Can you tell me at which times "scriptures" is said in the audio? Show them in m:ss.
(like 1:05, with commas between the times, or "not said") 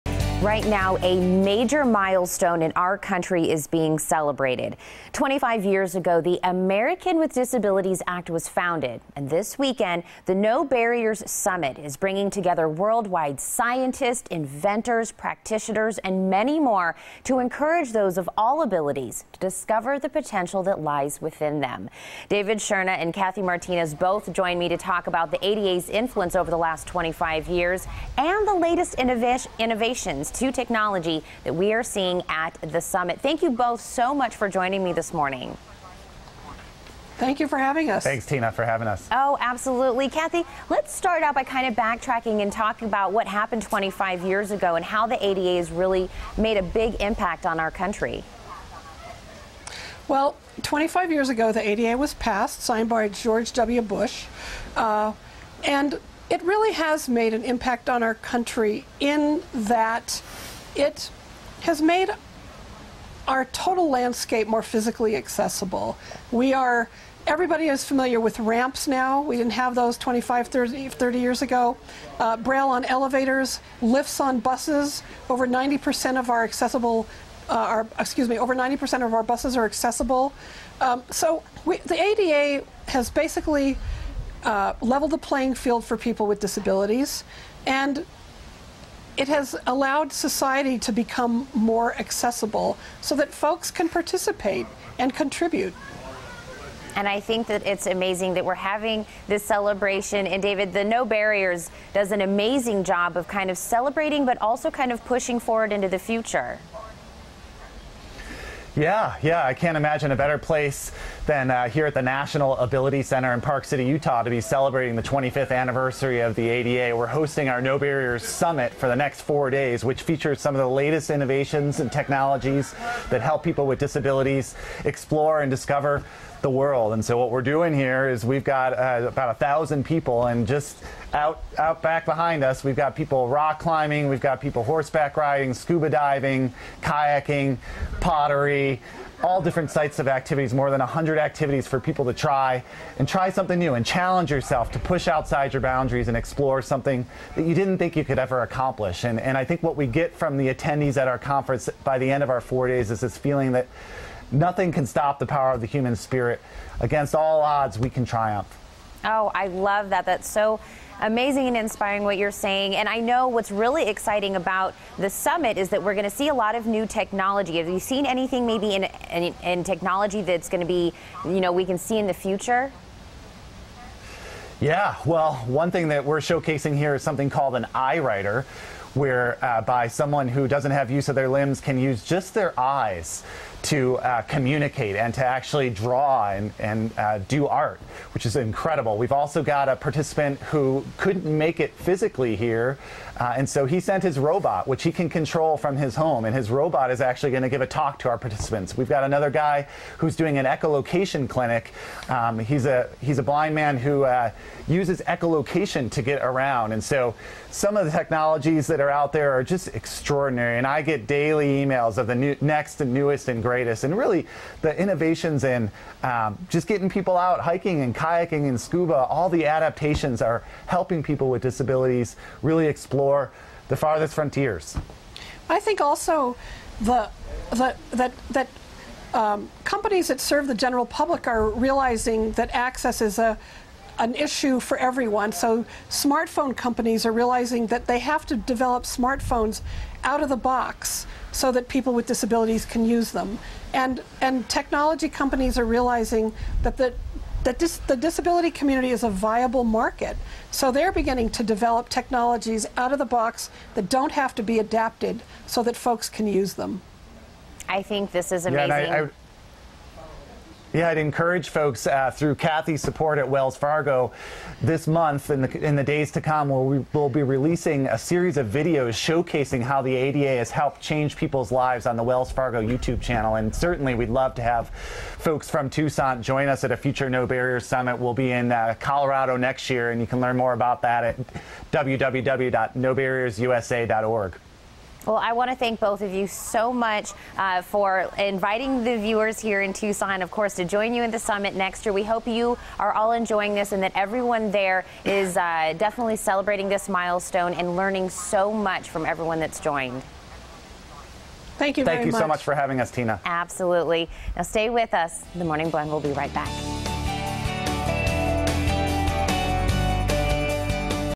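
not said.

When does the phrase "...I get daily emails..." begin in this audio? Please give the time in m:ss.
3:30.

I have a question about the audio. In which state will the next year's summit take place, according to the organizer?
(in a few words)
Colorado.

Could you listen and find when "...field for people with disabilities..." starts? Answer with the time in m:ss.
1:25.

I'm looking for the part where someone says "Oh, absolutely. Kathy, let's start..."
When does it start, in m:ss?
0:39.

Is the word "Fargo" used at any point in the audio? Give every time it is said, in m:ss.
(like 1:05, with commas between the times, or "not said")
4:23, 4:32.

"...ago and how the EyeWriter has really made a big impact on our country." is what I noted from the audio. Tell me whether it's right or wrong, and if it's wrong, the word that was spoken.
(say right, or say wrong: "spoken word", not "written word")
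wrong: "ADA", not "EyeWriter".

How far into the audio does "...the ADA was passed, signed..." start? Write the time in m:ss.
0:51.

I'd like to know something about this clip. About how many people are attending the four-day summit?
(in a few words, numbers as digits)
about 1000.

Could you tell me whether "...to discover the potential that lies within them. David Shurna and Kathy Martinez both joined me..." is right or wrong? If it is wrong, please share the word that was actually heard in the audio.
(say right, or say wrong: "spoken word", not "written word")
right.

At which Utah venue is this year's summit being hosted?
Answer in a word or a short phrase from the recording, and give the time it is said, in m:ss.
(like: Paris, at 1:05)
National Ability Center, at 1:52.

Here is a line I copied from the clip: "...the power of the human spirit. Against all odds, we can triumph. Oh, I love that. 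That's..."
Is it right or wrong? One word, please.
right.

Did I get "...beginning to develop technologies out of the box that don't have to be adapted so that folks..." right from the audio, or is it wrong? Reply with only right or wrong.
right.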